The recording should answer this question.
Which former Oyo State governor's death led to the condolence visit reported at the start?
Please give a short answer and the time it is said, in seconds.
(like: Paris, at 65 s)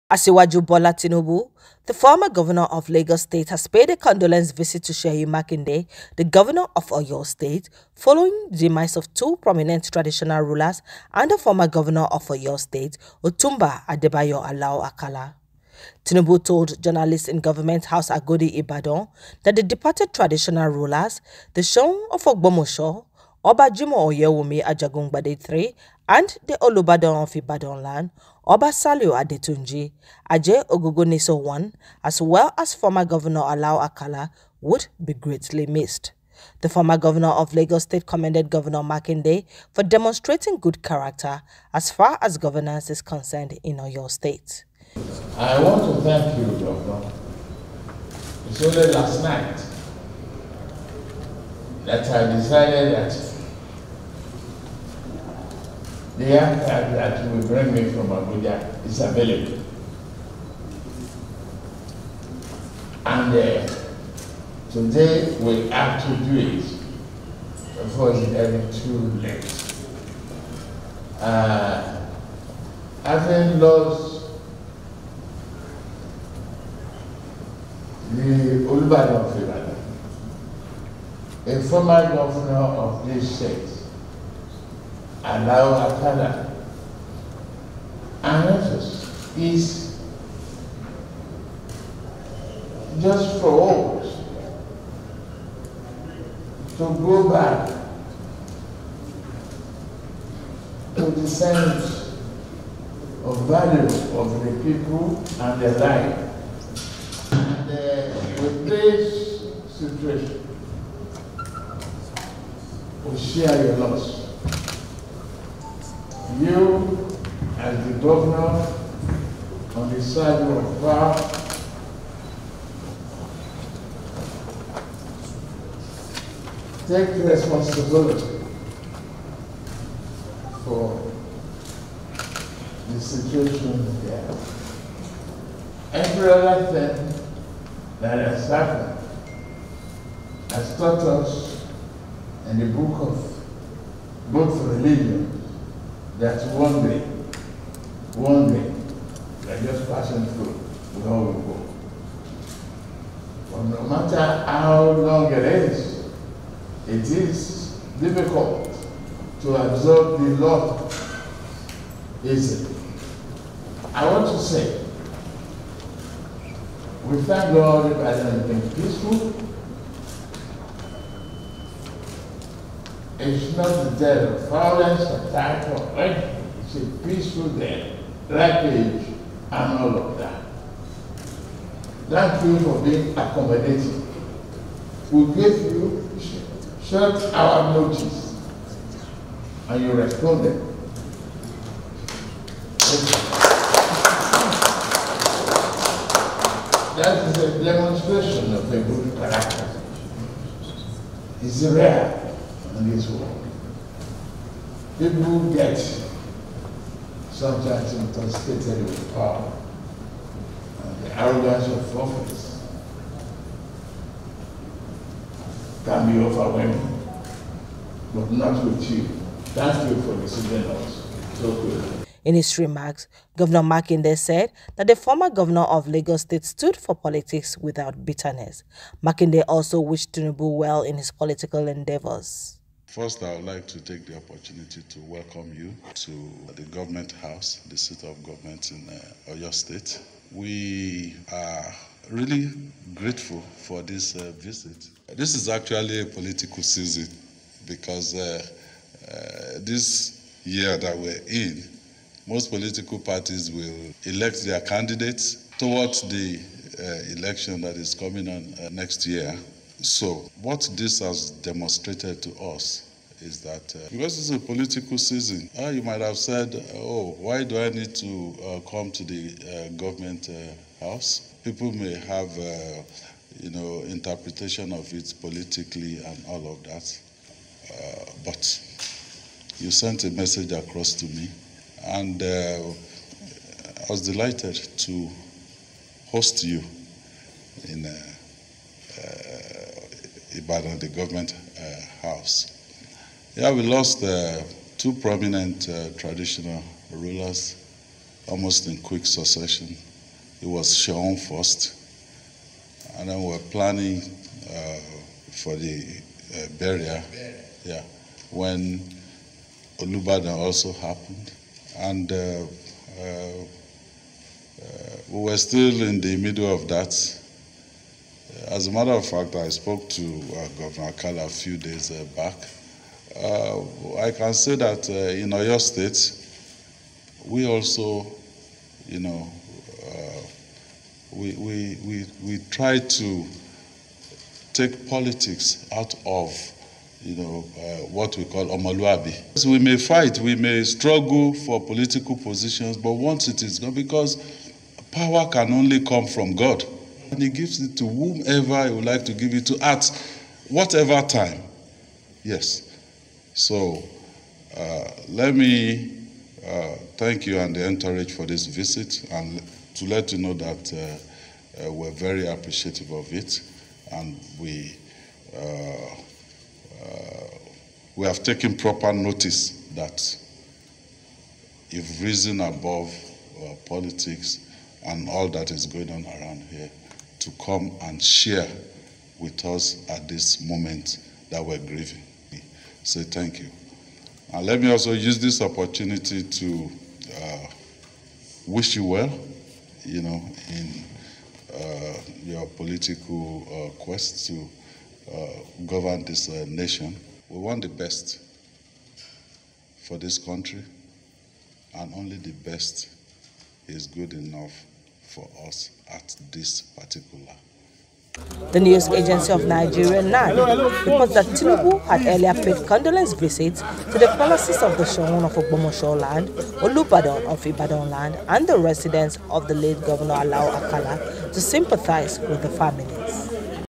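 Otunba Adebayo Alao Akala, at 13 s.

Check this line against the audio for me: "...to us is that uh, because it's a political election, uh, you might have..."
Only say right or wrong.
wrong.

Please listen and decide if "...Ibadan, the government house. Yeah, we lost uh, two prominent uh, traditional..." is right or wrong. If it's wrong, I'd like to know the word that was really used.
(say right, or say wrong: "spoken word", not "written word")
right.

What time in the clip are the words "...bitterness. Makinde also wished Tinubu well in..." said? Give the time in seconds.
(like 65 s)
228 s.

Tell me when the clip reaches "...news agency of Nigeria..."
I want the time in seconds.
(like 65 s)
408 s.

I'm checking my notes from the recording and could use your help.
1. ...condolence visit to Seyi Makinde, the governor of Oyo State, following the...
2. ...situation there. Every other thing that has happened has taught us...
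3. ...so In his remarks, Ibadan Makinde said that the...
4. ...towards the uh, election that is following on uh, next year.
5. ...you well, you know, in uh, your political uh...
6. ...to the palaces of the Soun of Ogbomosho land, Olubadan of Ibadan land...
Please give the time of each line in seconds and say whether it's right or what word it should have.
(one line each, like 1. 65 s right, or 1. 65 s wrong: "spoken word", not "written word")
1. 3 s right
2. 132 s right
3. 221 s wrong: "Governor", not "Ibadan"
4. 255 s wrong: "coming", not "following"
5. 388 s right
6. 413 s wrong: "Shogun", not "Soun".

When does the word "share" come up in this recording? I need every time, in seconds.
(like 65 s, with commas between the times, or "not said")
113 s, 378 s.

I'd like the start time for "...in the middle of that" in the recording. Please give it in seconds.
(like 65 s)
315 s.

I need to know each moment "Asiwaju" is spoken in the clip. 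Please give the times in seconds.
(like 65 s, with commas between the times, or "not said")
0 s.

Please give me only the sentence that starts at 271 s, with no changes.
People may have, uh, you know, interpretation of it politically and all of that.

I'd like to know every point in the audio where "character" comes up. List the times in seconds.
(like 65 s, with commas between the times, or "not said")
40 s, 199 s.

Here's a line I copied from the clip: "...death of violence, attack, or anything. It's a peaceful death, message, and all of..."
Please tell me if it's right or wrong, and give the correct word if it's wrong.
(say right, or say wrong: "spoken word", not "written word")
wrong: "rampage", not "message".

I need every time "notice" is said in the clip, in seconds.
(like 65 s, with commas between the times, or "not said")
187 s, 368 s.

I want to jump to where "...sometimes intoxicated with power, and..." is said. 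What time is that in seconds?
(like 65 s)
207 s.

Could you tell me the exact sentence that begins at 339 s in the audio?
We may fight, we may struggle for political positions, but once it is gone, because power can only come from God.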